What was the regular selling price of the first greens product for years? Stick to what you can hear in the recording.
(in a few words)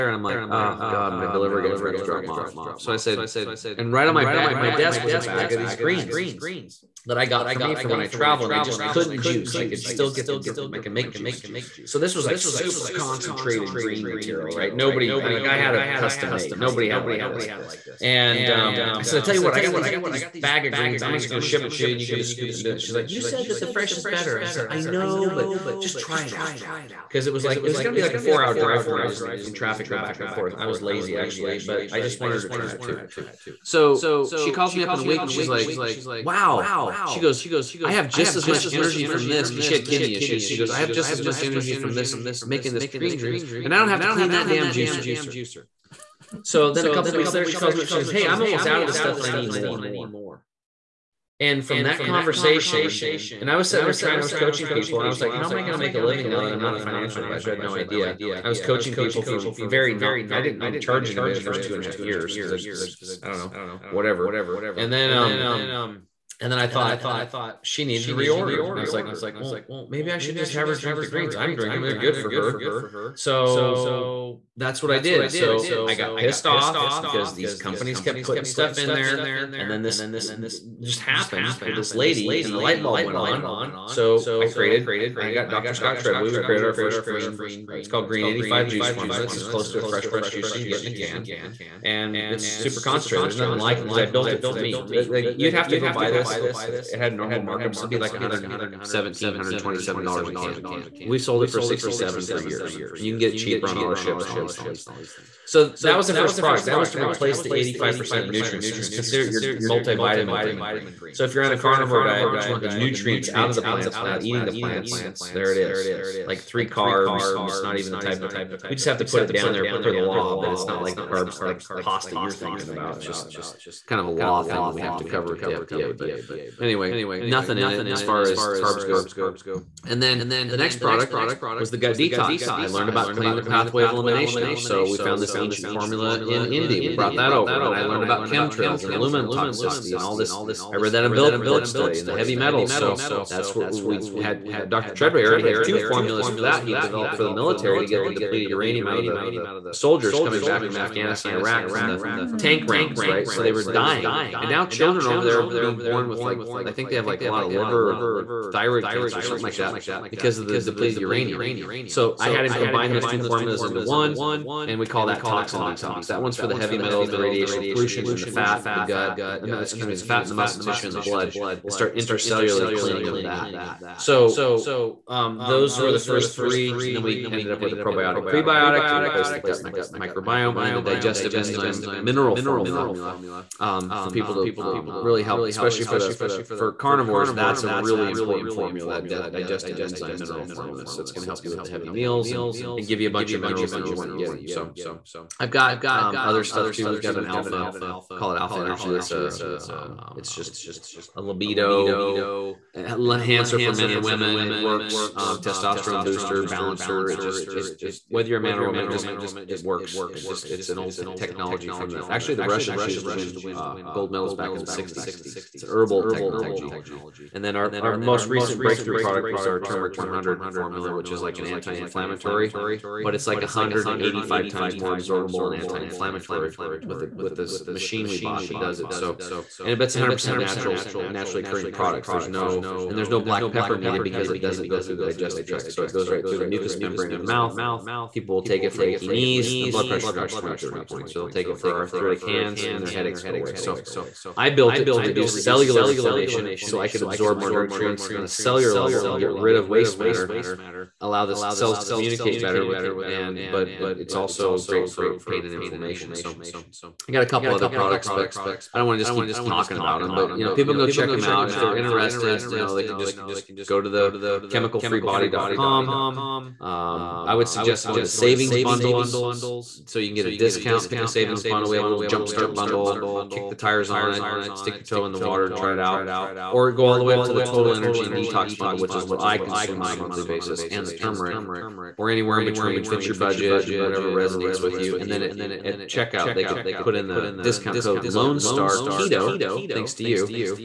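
$67.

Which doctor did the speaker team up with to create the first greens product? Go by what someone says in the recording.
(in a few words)
Scott Treadway.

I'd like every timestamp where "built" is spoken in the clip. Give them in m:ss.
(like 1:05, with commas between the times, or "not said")
1:34, 4:04.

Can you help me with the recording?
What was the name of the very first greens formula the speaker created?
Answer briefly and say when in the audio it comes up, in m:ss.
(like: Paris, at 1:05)
Green 85 juice formula, at 1:28.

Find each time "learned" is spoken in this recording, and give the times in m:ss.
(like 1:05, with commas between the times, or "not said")
2:12, 2:17.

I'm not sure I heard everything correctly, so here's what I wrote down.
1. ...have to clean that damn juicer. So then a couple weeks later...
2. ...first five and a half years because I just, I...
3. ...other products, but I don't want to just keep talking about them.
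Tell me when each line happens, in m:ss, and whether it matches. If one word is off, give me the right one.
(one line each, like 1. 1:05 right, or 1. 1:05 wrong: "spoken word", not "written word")
1. 0:43 right
2. 1:01 wrong: "two", not "five"
3. 4:17 right.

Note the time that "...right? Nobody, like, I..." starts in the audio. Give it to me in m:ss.
0:14.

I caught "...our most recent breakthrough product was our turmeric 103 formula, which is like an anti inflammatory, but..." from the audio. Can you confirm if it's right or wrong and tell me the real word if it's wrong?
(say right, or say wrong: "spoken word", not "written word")
wrong: "100", not "103".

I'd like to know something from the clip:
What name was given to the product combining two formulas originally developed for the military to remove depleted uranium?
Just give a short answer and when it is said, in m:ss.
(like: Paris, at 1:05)
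Toxin Detox, at 2:45.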